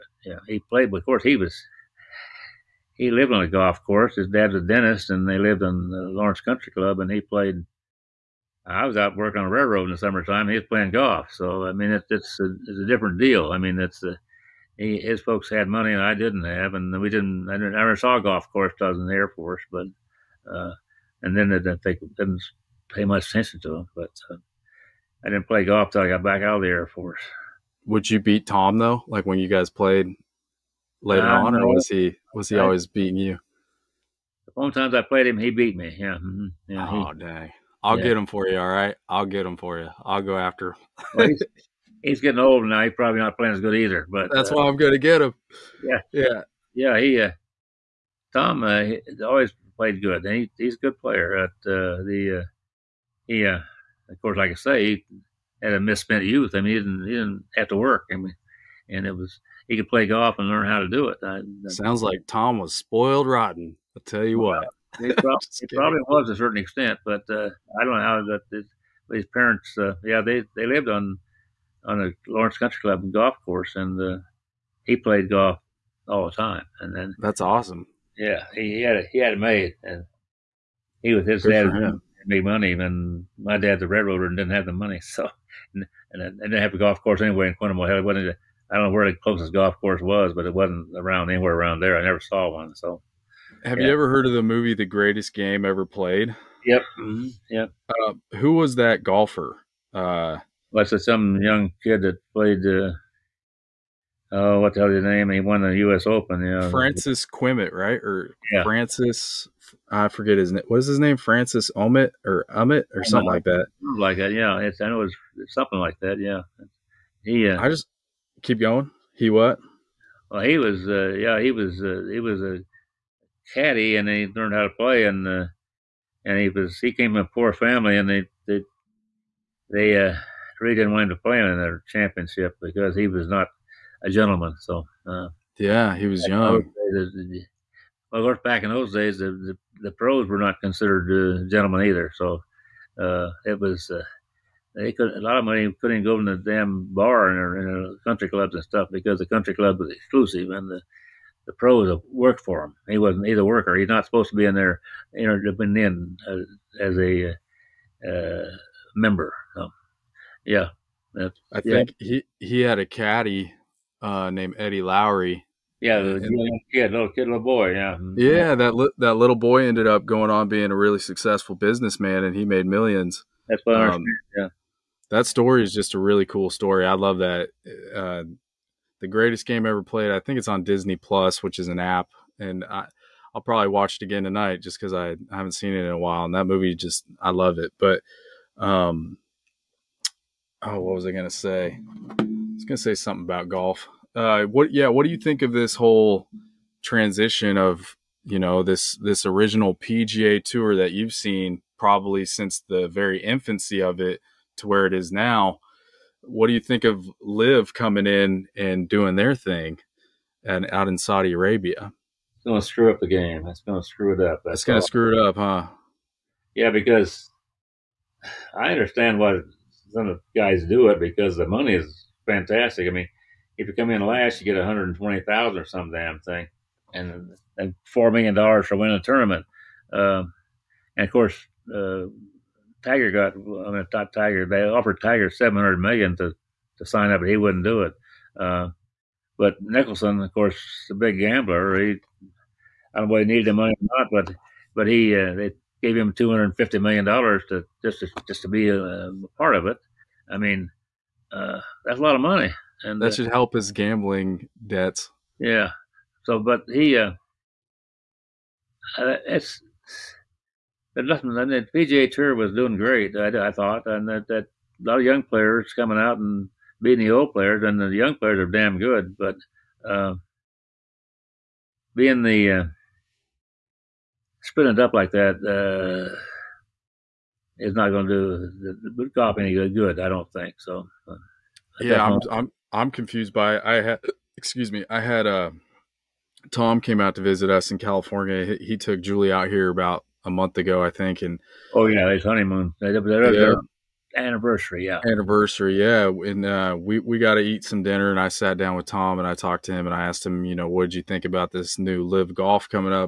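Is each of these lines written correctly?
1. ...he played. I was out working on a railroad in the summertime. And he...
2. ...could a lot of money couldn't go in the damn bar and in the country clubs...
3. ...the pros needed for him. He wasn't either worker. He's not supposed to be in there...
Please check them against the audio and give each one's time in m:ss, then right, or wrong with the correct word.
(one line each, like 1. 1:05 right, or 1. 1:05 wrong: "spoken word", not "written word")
1. 0:07 right
2. 2:24 right
3. 2:31 wrong: "worked", not "needed".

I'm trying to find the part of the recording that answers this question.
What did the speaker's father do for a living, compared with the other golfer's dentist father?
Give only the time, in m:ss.
1:23.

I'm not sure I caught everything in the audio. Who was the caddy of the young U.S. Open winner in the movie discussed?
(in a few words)
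Eddie Lowry.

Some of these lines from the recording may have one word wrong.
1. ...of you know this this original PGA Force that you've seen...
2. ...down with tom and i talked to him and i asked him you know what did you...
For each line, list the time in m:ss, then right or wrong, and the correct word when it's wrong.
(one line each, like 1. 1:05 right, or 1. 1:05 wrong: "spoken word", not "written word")
1. 3:17 wrong: "Tour", not "Force"
2. 4:58 right.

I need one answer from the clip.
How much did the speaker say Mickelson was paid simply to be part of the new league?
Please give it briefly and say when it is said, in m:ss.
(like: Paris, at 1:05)
250 million dollars, at 4:06.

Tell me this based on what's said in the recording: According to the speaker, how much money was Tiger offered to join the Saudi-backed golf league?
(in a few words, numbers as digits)
700 million.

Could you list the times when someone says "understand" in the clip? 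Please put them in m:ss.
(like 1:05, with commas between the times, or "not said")
2:53, 3:38.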